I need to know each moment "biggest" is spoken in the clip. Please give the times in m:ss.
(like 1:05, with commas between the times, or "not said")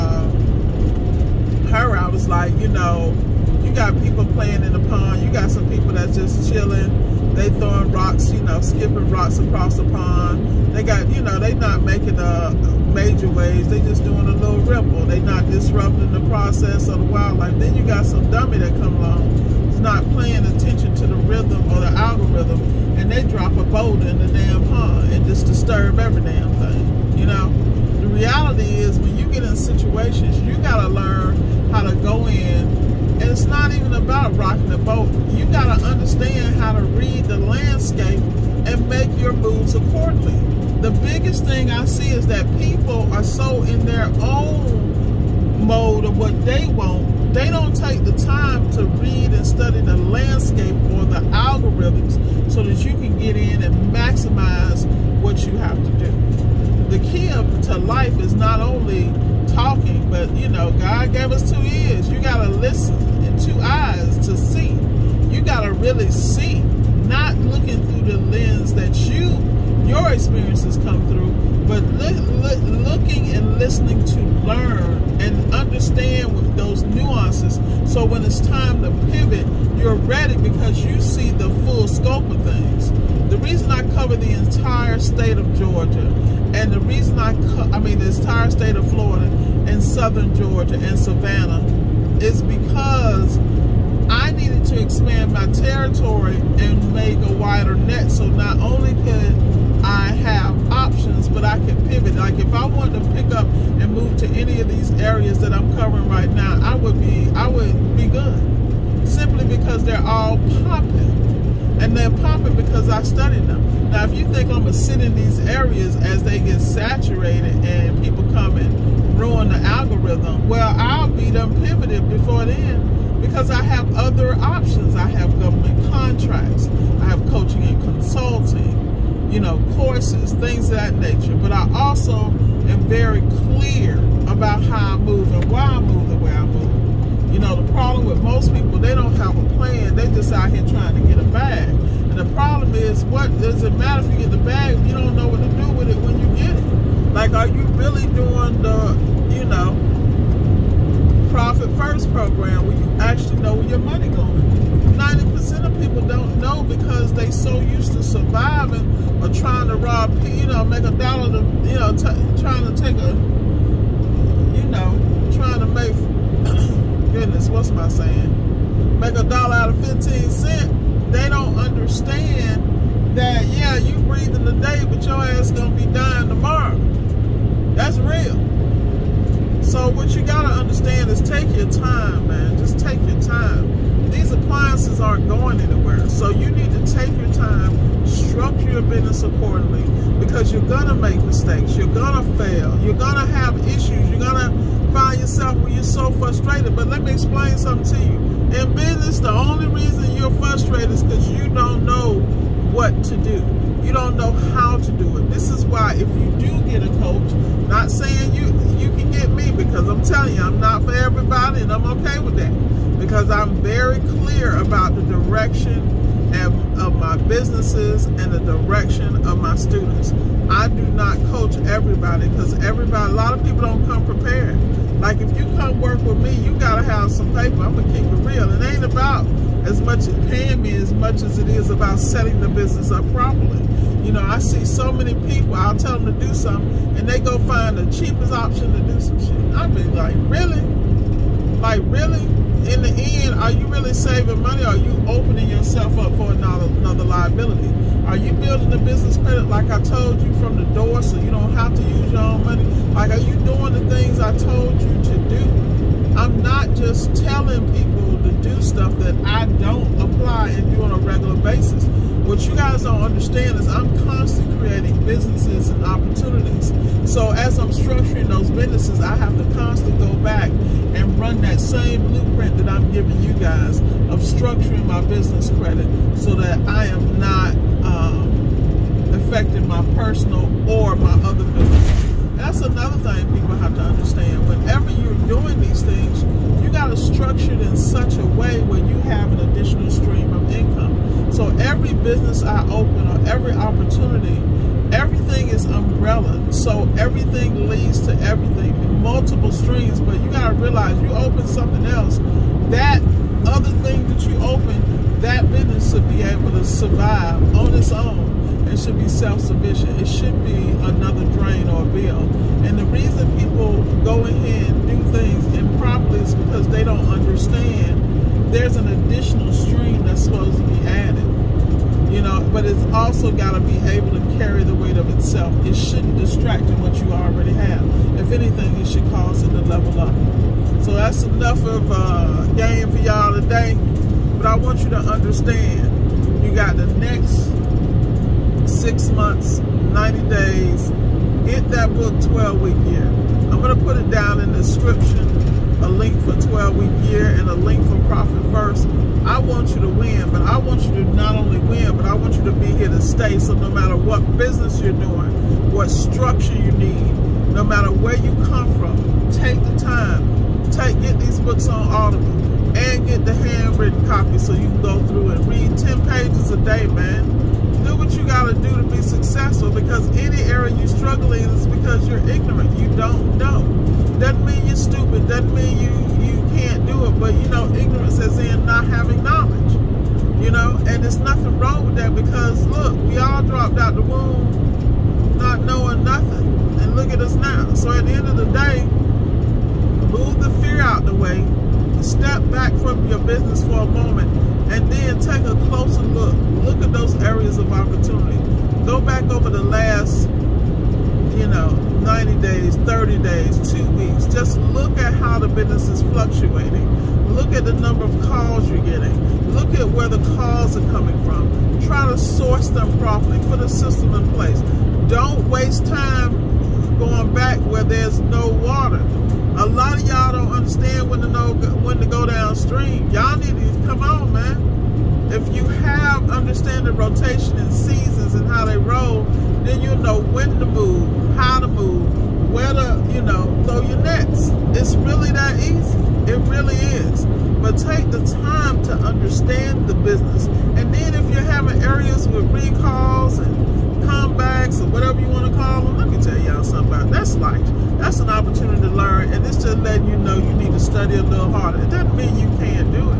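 0:40.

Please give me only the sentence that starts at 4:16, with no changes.
just telling people to do stuff that I don't apply and do on a regular basis.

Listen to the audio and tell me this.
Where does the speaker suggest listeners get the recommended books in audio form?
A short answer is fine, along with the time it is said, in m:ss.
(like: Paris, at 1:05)
Audible, at 6:01.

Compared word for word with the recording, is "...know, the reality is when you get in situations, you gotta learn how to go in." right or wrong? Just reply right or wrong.
right.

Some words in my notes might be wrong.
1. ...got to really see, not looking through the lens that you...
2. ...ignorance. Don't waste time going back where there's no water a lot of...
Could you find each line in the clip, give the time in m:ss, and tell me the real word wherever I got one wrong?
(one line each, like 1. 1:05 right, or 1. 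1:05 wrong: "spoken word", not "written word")
1. 1:05 right
2. 6:54 wrong: "place", not "ignorance".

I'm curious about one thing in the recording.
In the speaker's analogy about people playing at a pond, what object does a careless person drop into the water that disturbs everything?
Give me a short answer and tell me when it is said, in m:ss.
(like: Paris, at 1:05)
a boulder, at 0:23.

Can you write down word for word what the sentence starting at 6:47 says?
Look at the number of calls you're getting.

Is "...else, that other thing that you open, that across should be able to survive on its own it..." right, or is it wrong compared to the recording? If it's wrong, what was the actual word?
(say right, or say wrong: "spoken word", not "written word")
wrong: "business", not "across".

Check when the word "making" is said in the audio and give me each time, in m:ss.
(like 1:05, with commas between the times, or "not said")
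0:11.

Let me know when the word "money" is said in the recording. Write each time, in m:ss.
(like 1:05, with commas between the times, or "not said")
2:33, 4:04, 4:12.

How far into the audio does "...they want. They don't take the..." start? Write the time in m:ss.
0:46.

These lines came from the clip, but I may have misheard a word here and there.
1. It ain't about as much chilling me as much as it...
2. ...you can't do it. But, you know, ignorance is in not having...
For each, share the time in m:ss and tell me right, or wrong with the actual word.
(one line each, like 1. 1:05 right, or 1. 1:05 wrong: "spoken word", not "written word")
1. 3:48 wrong: "paying", not "chilling"
2. 6:16 right.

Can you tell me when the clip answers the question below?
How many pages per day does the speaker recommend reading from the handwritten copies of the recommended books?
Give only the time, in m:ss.
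6:05.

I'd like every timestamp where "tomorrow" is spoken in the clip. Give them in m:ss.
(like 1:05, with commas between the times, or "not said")
2:56.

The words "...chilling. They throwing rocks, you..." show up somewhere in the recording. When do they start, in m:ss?
0:06.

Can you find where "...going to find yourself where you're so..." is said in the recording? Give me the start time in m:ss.
3:14.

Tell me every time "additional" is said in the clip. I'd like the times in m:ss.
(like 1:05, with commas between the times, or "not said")
4:49, 5:18.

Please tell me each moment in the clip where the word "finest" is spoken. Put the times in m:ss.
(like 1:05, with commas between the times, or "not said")
not said.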